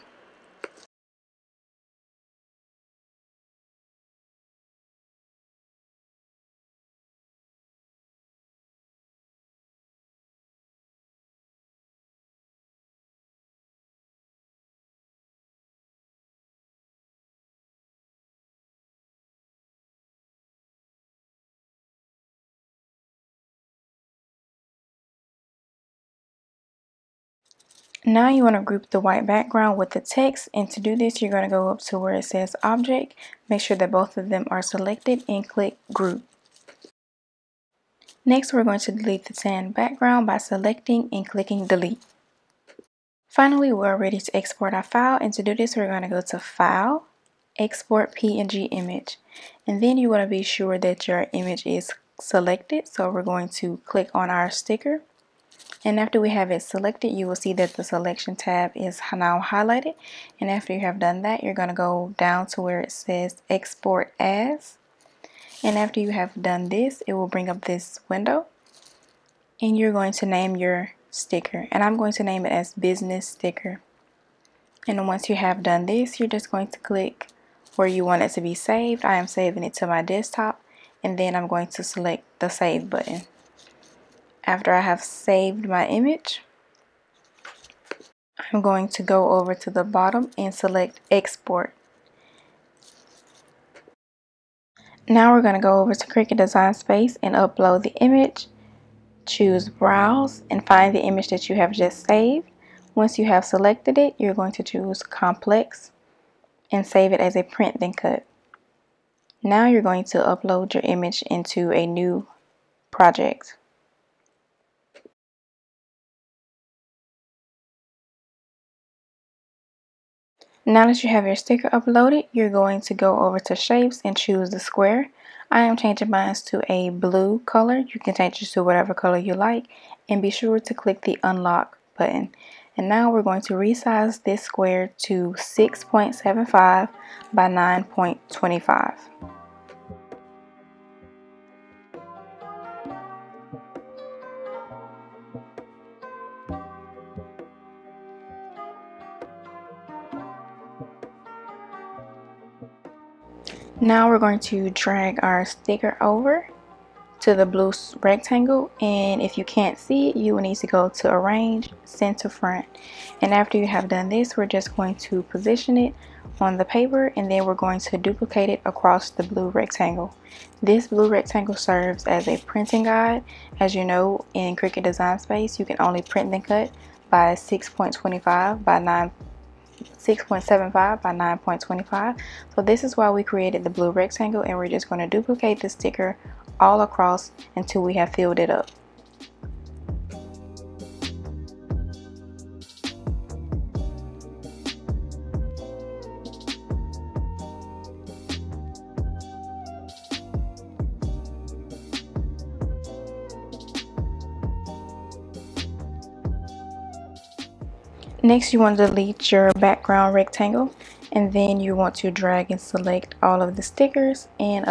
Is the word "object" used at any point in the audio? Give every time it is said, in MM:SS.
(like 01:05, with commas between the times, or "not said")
00:32.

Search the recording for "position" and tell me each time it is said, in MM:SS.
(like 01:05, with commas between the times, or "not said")
02:45.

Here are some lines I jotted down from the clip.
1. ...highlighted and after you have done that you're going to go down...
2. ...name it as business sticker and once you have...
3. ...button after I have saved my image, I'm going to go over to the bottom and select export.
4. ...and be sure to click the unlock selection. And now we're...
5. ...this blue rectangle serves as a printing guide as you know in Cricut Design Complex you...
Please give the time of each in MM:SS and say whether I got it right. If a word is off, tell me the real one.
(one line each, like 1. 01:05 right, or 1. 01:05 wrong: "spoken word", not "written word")
1. 00:59 right
2. 01:12 right
3. 01:22 right
4. 02:10 wrong: "button", not "selection"
5. 02:50 wrong: "Space", not "Complex".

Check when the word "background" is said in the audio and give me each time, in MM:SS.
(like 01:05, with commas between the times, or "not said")
00:29, 00:39, 03:29.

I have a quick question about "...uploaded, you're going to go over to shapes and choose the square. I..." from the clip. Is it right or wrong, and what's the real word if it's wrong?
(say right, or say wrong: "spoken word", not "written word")
right.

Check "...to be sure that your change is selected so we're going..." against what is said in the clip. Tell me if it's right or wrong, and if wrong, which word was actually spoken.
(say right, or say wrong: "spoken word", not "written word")
wrong: "image", not "change".